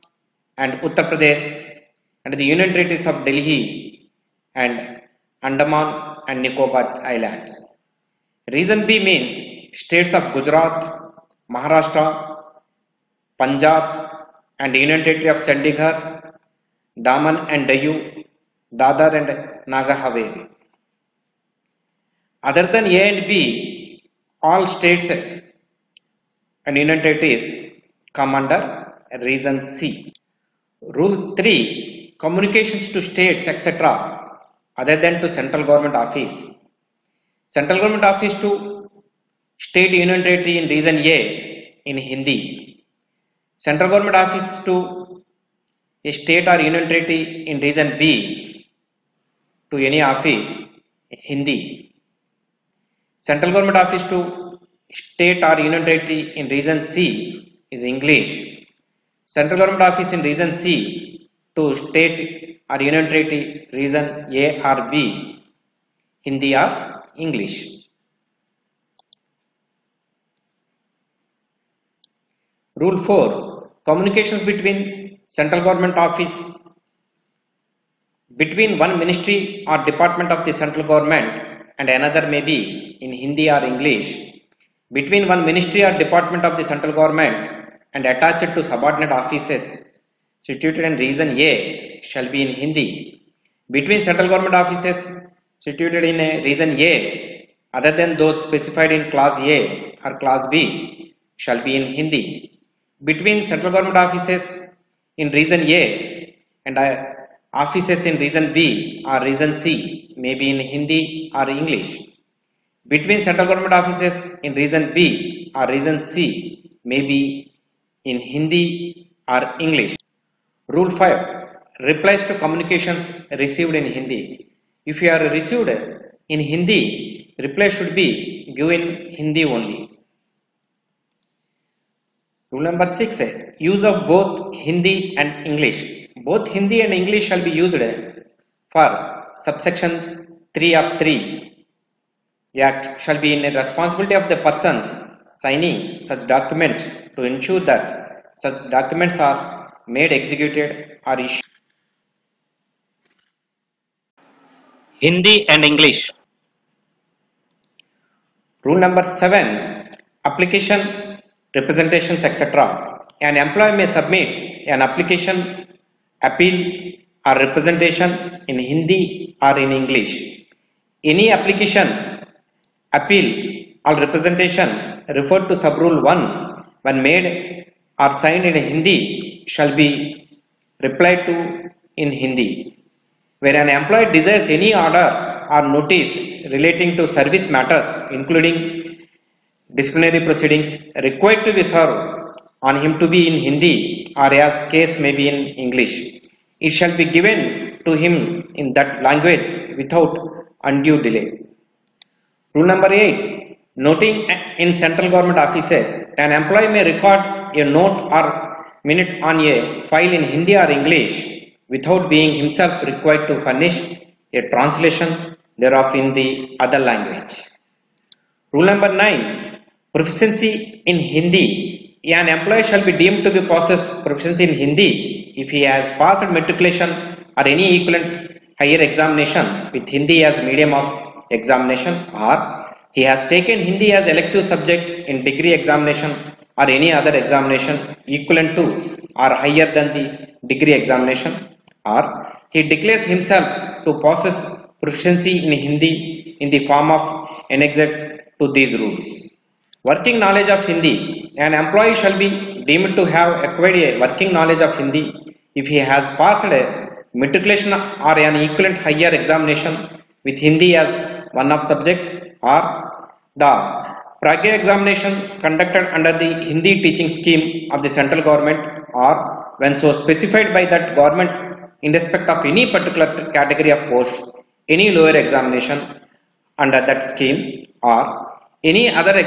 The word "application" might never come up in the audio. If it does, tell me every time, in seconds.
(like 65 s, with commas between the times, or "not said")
160 s, 164 s, 171 s.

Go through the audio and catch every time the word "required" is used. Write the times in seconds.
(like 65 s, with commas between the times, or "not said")
191 s, 212 s.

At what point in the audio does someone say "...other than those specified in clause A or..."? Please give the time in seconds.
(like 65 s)
97 s.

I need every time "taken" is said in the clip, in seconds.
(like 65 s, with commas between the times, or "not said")
233 s.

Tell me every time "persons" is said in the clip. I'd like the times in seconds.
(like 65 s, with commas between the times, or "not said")
144 s.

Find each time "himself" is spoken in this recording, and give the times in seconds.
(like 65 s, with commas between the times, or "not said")
212 s, 243 s.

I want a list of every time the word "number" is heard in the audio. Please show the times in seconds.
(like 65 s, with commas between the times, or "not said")
132 s, 158 s, 202 s, 218 s.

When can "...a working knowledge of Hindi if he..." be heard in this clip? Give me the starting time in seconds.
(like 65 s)
253 s.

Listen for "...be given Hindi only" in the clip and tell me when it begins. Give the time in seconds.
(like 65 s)
127 s.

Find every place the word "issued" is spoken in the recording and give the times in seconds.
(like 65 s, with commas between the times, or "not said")
151 s.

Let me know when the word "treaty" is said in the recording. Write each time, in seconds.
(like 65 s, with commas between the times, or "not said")
46 s, 55 s, 63 s.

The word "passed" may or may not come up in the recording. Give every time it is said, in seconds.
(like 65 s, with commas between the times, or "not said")
225 s, 256 s.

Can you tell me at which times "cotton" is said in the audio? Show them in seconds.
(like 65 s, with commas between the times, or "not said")
not said.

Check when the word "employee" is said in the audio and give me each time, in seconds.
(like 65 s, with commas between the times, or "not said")
163 s, 183 s, 206 s, 222 s, 251 s.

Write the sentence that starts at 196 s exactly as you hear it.
It shall be given to him in that language without undue delay.